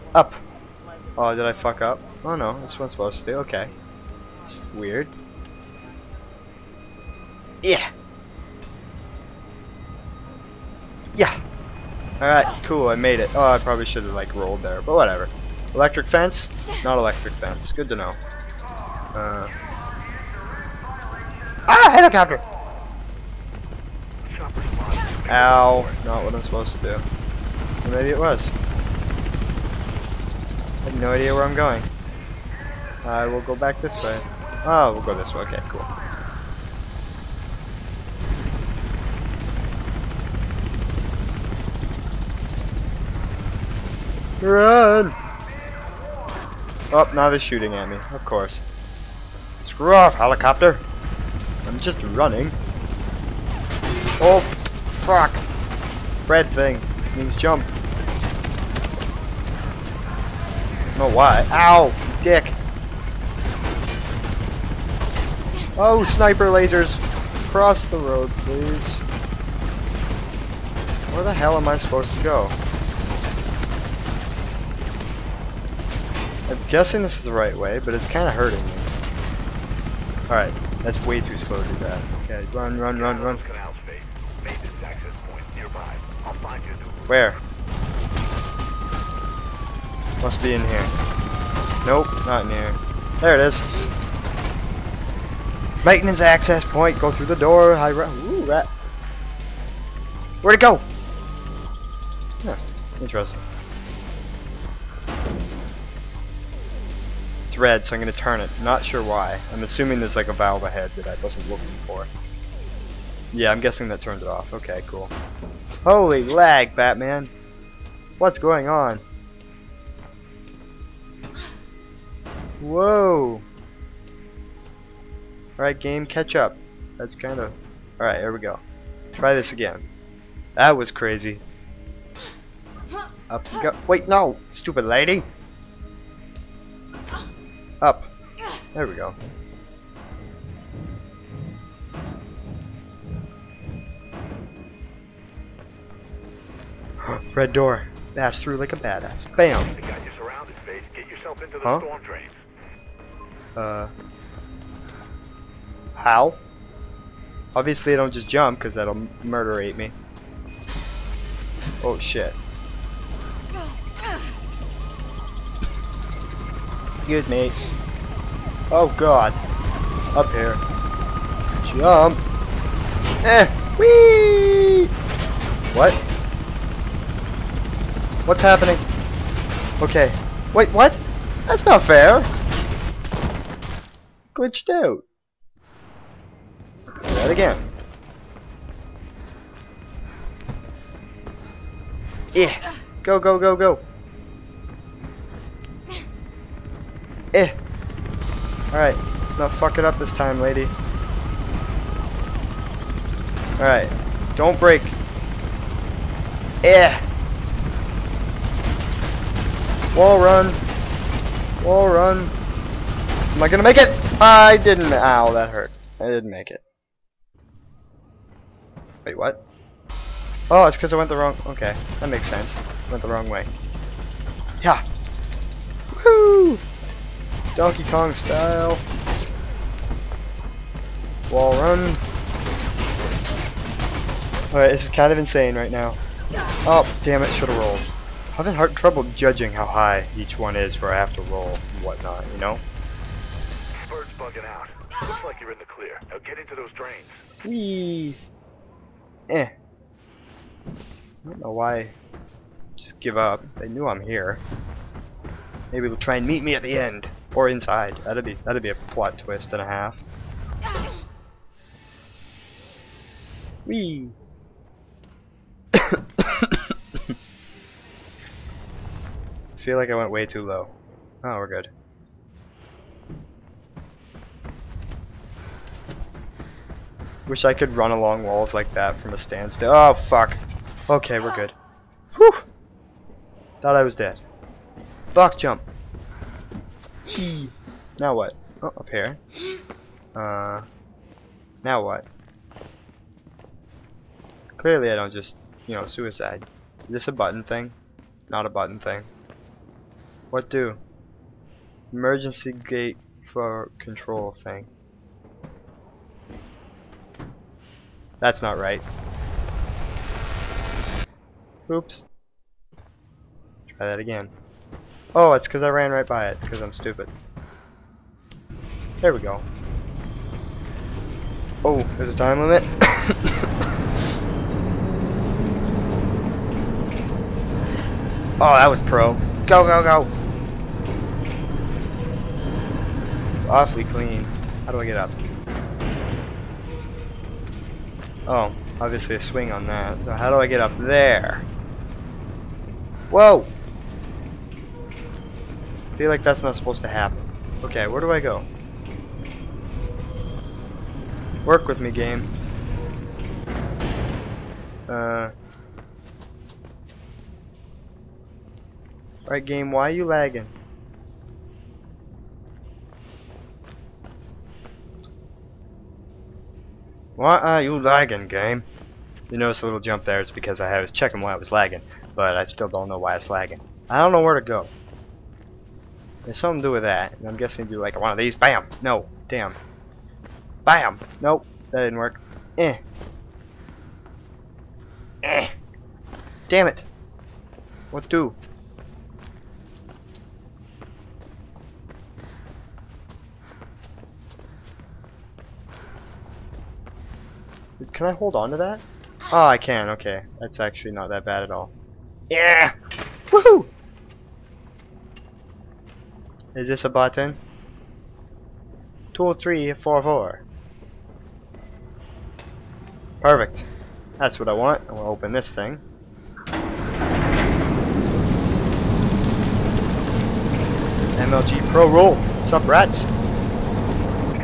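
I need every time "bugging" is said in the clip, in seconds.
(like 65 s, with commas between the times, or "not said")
244 s.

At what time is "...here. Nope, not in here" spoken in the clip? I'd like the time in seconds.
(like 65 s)
90 s.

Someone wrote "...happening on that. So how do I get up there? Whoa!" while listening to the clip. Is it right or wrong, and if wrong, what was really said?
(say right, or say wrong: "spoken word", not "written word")
wrong: "swing", not "happening".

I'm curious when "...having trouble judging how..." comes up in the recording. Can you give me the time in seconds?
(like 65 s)
238 s.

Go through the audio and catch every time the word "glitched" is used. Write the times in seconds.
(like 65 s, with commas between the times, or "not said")
184 s.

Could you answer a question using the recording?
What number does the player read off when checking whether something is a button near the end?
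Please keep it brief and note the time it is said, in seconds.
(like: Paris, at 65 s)
20344, at 409 s.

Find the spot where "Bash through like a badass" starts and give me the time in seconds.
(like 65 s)
148 s.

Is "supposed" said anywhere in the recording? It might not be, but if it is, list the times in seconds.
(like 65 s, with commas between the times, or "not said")
2 s, 26 s, 71 s, 346 s.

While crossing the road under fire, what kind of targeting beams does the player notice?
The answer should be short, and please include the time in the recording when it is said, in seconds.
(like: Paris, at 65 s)
Sniper lasers, at 66 s.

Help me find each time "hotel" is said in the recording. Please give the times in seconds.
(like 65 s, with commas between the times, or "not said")
not said.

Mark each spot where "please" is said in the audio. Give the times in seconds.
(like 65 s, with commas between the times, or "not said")
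68 s.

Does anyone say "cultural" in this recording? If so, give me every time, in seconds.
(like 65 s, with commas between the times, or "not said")
not said.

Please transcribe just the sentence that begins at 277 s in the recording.
Wish I could run along walls like that from a standstill.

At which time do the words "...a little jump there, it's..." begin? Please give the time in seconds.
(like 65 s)
369 s.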